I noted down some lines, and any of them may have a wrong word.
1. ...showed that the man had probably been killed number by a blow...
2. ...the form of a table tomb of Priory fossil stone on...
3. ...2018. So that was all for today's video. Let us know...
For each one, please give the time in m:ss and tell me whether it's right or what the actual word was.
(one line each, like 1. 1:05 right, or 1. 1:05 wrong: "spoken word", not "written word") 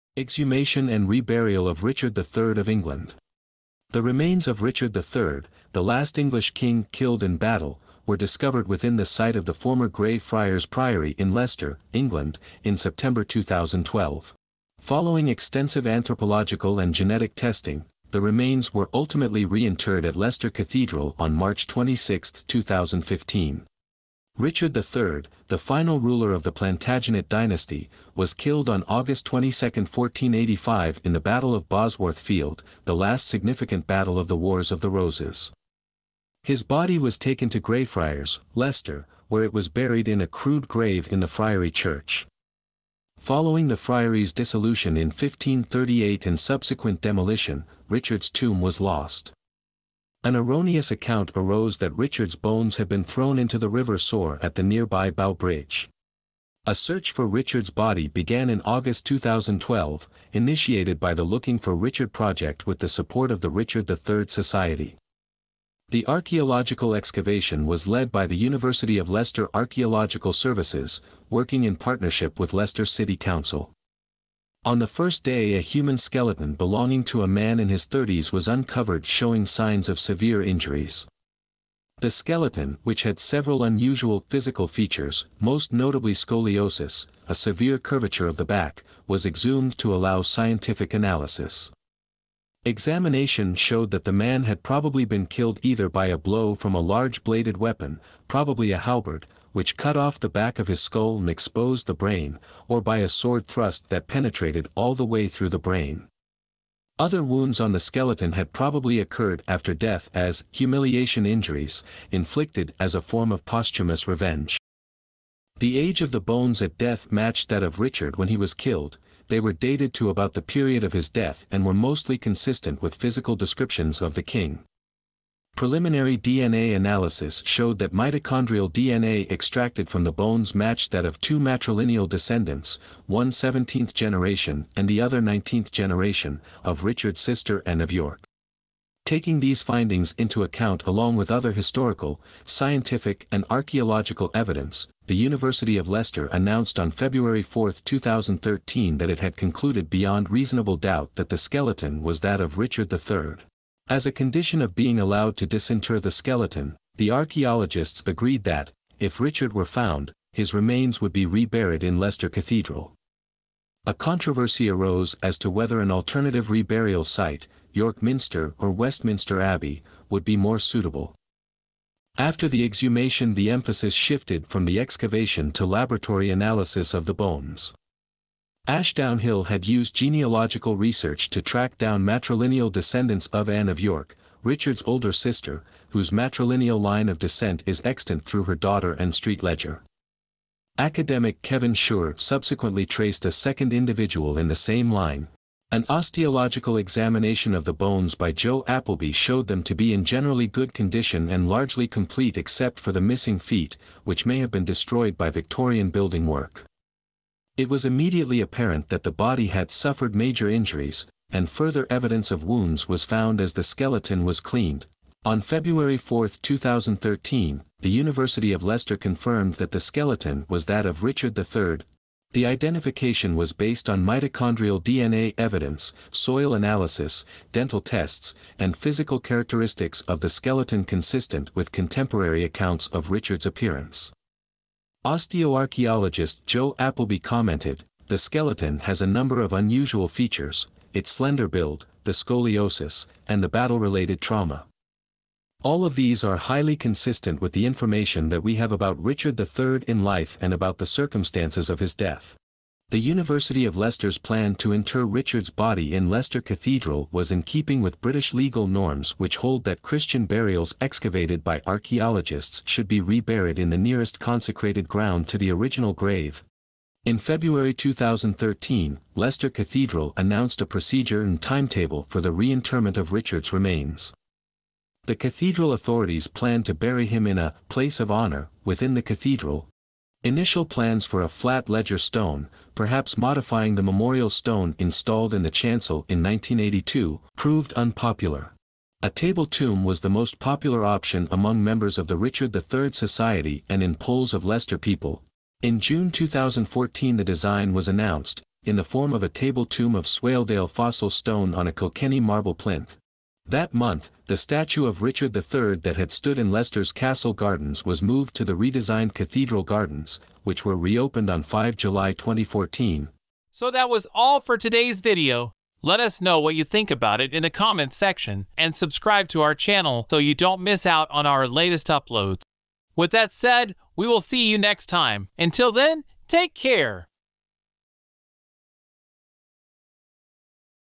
1. 1:33 wrong: "either", not "number"
2. 4:58 wrong: "Swaledale", not "Priory"
3. 5:12 wrong: "2014", not "2018".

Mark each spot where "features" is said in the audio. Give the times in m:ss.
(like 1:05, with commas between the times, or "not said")
1:24, 4:00.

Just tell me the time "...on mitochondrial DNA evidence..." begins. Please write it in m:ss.
3:43.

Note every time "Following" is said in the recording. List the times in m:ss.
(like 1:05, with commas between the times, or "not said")
0:14, 0:43.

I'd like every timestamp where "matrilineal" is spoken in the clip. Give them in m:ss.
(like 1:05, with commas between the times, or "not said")
2:11, 3:02, 3:06.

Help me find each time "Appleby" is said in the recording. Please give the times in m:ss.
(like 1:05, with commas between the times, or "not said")
3:18, 3:56.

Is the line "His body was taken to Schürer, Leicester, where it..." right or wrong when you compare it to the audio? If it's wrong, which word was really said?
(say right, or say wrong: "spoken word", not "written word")
wrong: "Greyfriars", not "Schürer".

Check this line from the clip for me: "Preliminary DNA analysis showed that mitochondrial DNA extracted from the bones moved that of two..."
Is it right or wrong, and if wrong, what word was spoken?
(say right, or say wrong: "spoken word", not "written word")
wrong: "matched", not "moved".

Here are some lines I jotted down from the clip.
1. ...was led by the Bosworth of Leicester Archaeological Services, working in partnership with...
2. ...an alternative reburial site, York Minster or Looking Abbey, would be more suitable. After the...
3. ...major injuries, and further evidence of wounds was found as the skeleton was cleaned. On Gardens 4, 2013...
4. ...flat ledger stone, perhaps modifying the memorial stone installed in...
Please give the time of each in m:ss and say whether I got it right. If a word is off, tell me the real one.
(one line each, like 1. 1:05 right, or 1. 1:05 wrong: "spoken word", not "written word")
1. 1:07 wrong: "University", not "Bosworth"
2. 2:45 wrong: "Westminster", not "Looking"
3. 3:30 wrong: "February", not "Gardens"
4. 4:41 right.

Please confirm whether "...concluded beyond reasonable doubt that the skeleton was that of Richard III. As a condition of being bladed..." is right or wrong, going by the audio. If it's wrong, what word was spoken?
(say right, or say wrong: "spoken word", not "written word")
wrong: "allowed", not "bladed".